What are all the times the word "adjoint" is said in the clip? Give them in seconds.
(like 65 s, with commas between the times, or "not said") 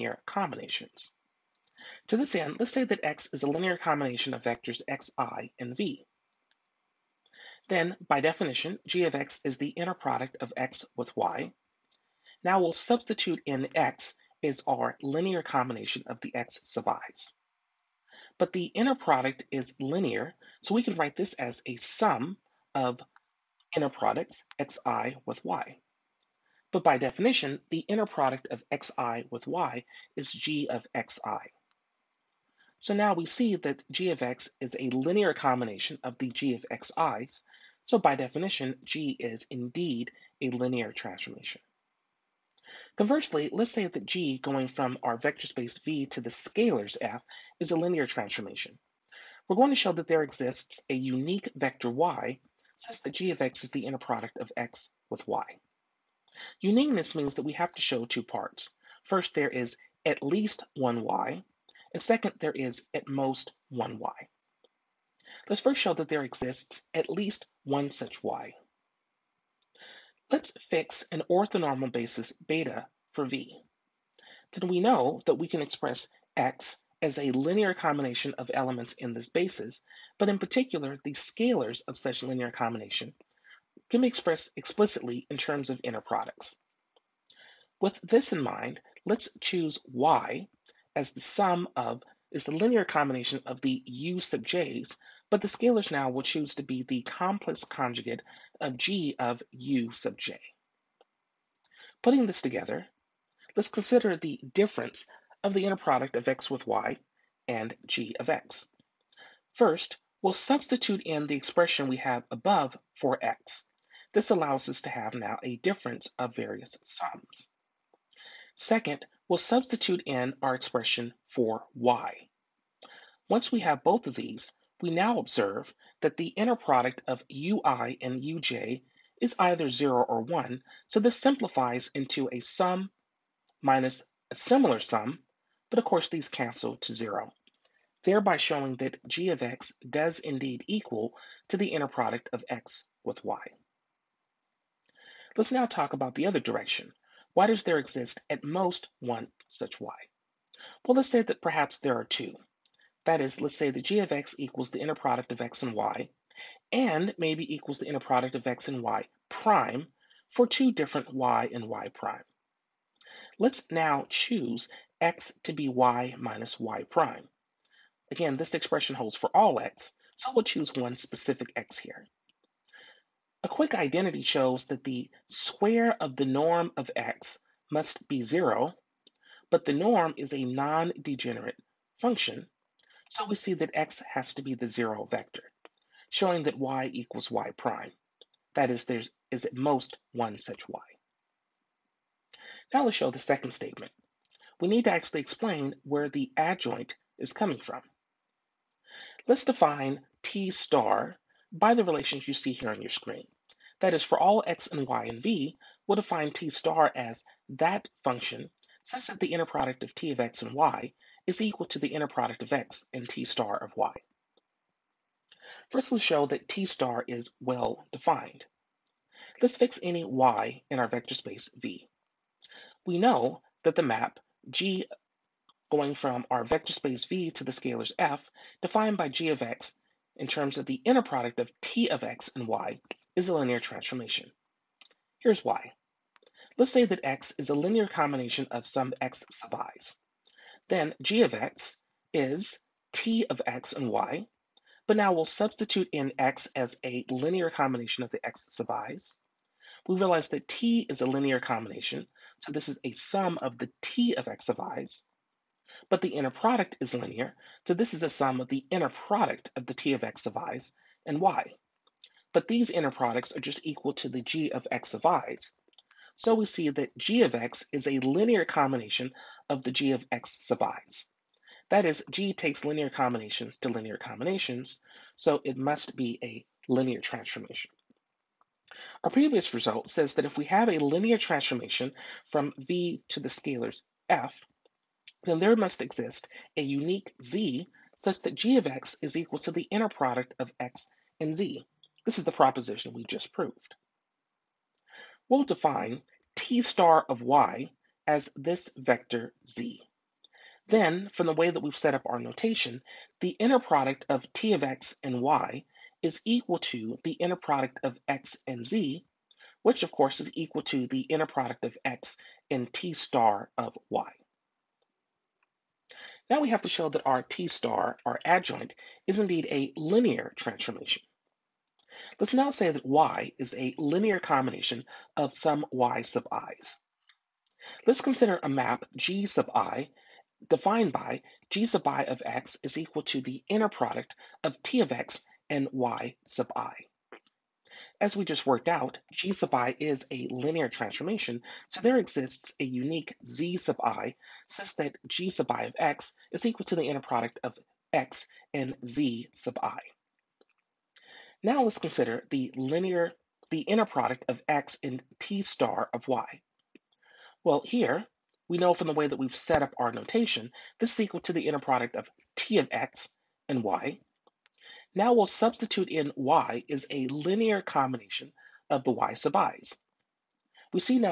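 196 s, 318 s.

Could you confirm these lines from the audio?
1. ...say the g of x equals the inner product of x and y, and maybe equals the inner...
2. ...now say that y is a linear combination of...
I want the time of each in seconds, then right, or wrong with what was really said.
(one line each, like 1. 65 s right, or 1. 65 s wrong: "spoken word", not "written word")
1. 153 s right
2. 322 s right.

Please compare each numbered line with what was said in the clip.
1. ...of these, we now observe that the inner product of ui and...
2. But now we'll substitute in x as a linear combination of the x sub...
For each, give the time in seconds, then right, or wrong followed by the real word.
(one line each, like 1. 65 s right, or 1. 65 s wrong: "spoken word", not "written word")
1. 124 s right
2. 244 s right.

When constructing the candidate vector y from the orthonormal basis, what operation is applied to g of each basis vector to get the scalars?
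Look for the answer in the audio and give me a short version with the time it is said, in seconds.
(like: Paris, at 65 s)
complex conjugate, at 97 s.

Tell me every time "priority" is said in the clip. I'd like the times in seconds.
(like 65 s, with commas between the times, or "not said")
not said.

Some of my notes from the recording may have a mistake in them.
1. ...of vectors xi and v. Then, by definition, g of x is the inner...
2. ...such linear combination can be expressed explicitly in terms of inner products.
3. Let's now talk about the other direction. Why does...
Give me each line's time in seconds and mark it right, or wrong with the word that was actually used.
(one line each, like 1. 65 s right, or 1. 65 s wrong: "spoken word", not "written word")
1. 4 s right
2. 81 s right
3. 145 s right.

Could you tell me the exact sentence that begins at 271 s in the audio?
That is, g takes linear combinations to linear combinations, so it must be a linear transformation.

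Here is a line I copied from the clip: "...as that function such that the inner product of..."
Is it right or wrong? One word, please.
right.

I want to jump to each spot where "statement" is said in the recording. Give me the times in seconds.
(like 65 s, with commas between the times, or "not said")
193 s.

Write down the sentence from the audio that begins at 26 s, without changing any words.
But by definition, the inner product of xi with y is g of xi.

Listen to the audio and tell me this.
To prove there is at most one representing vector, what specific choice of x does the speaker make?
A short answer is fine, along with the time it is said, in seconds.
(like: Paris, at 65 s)
y minus y prime, at 165 s.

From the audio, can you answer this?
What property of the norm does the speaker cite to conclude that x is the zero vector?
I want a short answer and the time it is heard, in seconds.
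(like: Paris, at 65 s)
non-degenerate, at 180 s.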